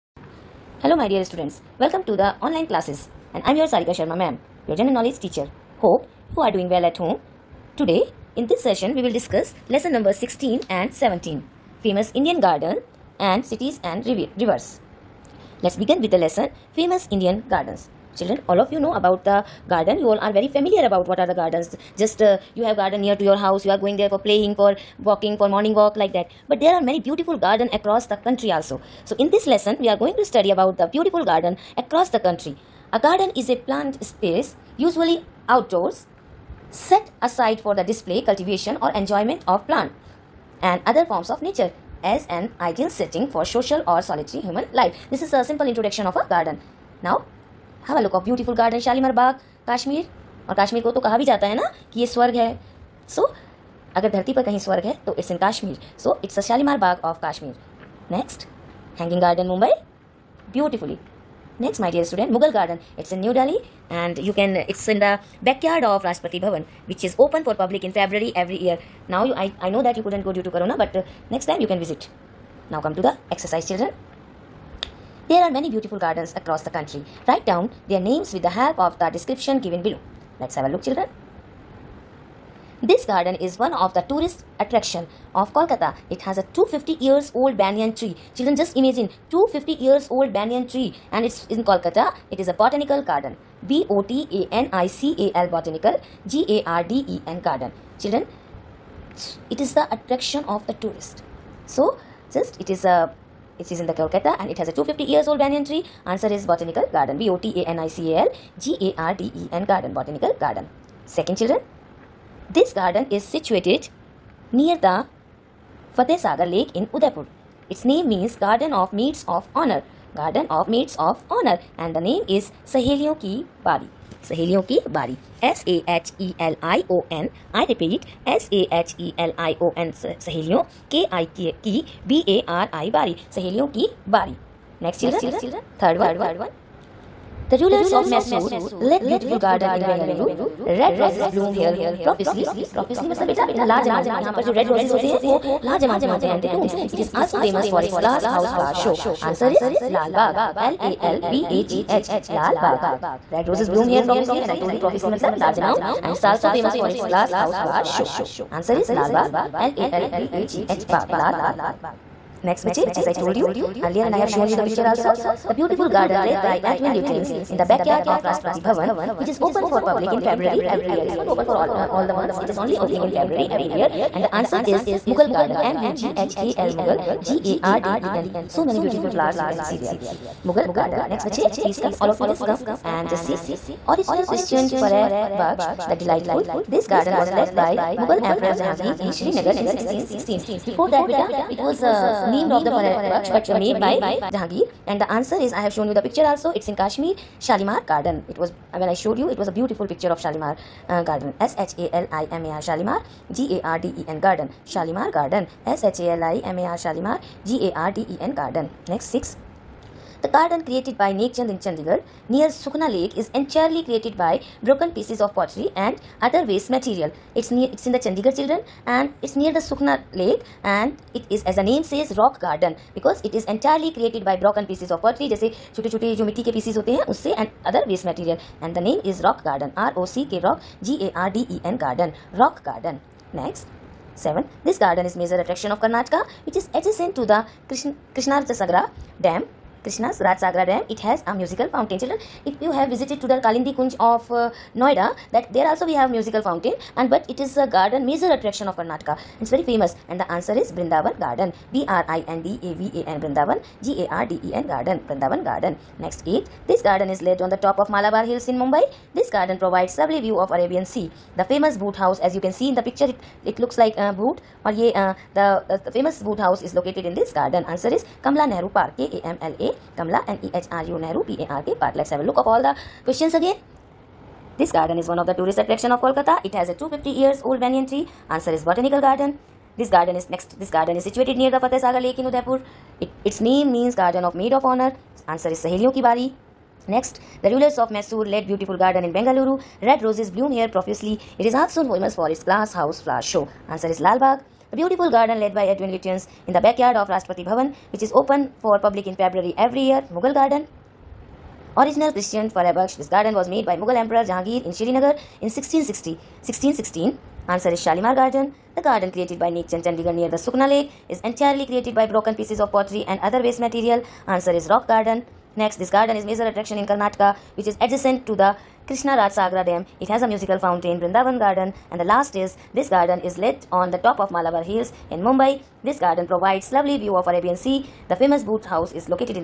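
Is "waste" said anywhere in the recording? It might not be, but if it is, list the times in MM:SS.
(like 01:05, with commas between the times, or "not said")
03:36, 03:47, 05:13.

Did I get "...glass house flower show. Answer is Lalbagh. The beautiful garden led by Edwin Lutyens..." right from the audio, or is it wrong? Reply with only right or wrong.
right.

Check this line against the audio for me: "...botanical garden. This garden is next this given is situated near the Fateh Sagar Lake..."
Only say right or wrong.
wrong.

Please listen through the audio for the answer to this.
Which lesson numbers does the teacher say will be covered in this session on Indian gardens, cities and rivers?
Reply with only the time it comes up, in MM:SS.
00:10.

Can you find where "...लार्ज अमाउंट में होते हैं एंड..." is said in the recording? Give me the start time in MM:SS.
02:25.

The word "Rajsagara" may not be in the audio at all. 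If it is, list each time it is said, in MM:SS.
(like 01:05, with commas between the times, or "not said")
04:00.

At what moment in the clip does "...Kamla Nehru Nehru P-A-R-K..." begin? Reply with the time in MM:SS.
04:29.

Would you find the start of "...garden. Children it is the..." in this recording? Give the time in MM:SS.
01:37.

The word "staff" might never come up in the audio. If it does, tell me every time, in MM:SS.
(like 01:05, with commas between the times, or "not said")
not said.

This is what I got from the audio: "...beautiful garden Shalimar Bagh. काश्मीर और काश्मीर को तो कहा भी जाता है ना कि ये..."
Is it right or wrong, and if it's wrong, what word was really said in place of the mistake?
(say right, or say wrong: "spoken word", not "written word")
right.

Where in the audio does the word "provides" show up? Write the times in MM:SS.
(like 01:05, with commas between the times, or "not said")
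04:19, 05:26.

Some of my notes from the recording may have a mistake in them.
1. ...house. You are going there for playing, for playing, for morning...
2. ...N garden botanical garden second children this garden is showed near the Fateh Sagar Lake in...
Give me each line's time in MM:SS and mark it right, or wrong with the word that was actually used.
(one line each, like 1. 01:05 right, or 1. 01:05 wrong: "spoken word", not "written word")
1. 00:23 wrong: "walking", not "playing"
2. 01:49 wrong: "situated", not "showed".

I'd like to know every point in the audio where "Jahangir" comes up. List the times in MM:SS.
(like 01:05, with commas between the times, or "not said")
03:08, 03:14, 05:04.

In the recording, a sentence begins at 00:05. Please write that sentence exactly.
Hope you are doing well at home.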